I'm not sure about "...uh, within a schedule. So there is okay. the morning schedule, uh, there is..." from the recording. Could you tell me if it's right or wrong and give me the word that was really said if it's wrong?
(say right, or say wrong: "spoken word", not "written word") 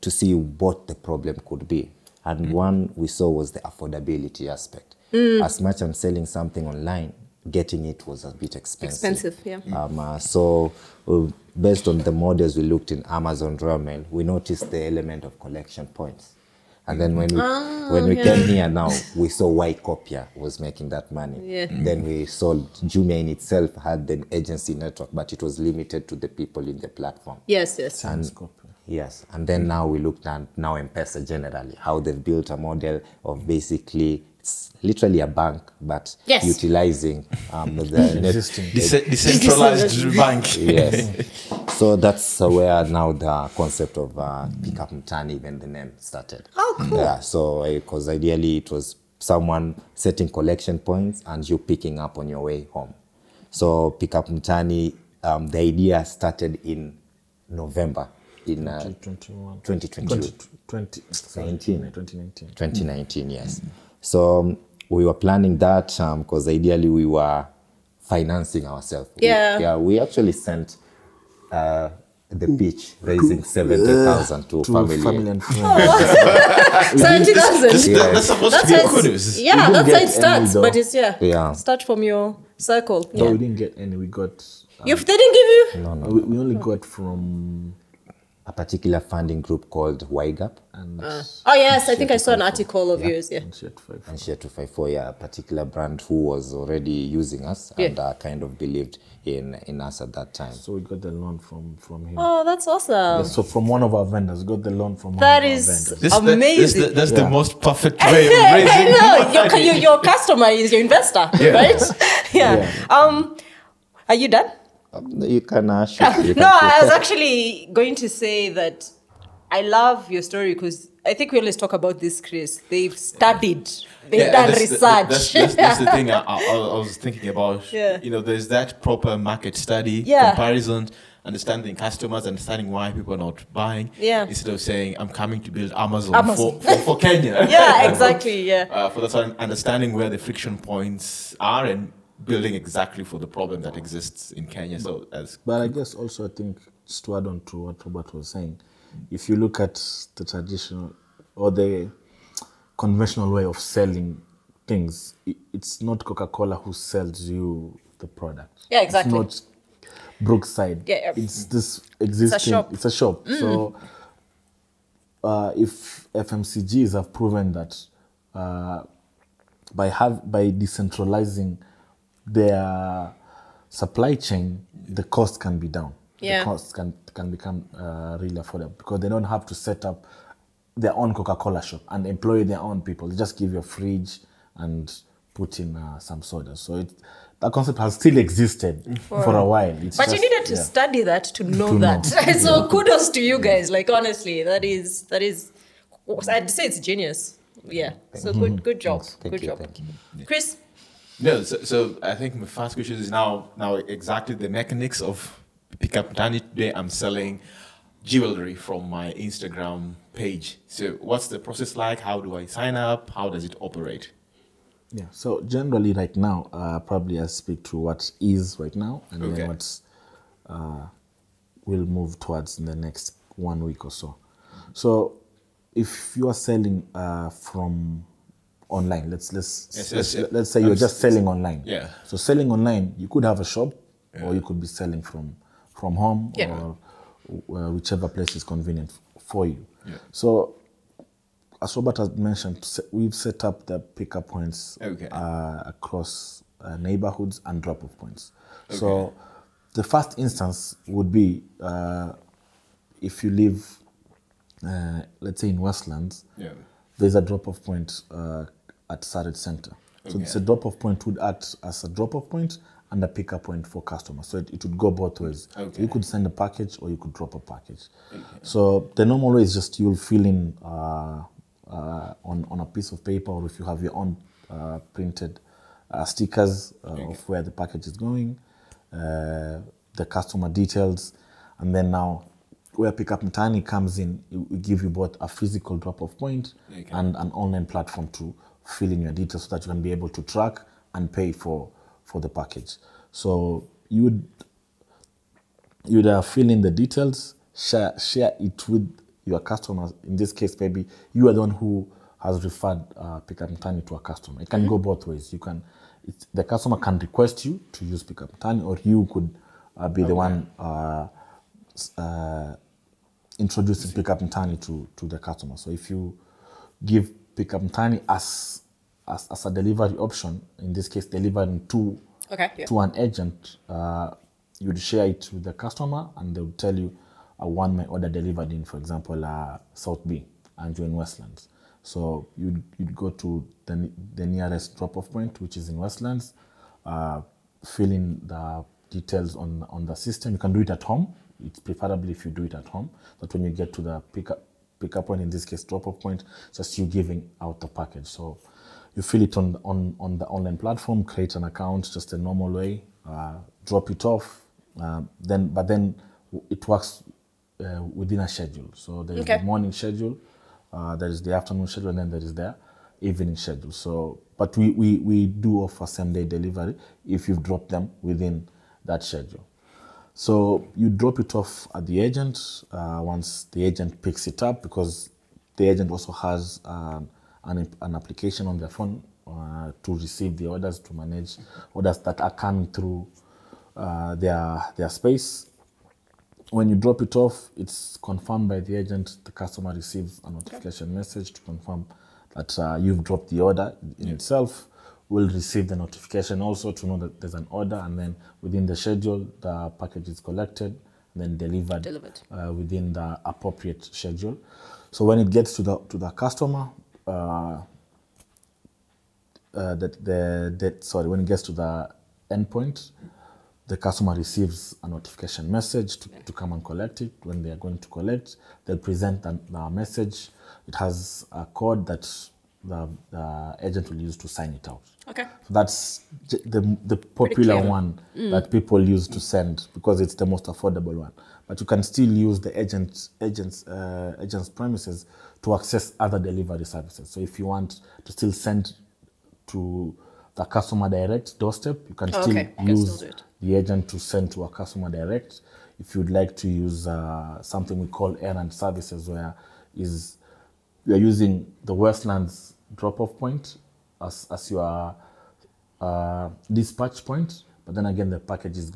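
right.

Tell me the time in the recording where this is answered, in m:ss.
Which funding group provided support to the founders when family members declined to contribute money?
1:30.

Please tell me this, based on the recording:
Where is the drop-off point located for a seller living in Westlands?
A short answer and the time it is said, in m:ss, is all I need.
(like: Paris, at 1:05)
Sarit Center, at 4:19.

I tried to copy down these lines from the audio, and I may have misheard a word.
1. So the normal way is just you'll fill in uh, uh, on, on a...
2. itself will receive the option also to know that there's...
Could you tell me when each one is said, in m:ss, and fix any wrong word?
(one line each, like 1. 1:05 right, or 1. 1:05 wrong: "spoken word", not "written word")
1. 4:28 right
2. 6:34 wrong: "notification", not "option".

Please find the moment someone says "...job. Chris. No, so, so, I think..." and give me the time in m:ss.
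3:19.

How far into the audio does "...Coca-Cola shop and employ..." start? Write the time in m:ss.
3:01.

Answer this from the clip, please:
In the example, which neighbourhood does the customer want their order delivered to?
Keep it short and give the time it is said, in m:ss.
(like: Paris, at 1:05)
South B, at 5:29.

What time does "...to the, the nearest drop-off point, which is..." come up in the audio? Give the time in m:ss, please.
5:33.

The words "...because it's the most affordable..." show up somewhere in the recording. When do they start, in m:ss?
7:09.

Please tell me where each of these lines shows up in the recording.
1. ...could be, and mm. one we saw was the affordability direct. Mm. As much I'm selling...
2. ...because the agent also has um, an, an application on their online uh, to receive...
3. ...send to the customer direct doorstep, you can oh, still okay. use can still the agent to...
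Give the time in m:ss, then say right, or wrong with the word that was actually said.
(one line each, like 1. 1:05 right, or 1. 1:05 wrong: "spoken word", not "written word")
1. 0:01 wrong: "aspect", not "direct"
2. 6:14 wrong: "phone", not "online"
3. 7:18 right.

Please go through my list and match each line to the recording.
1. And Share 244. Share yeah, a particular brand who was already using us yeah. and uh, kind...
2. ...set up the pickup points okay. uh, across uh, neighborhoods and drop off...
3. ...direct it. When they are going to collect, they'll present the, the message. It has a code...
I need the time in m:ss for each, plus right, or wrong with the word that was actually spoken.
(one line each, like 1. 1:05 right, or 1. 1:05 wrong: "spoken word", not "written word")
1. 1:33 wrong: "254", not "244"
2. 4:03 right
3. 6:56 wrong: "collect", not "direct".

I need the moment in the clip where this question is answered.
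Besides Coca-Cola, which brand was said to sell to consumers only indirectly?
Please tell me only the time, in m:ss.
2:40.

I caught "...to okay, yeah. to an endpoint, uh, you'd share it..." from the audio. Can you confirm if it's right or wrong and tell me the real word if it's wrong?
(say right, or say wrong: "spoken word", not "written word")
wrong: "agent", not "endpoint".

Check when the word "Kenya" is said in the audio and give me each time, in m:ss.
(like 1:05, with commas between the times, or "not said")
2:16, 2:24.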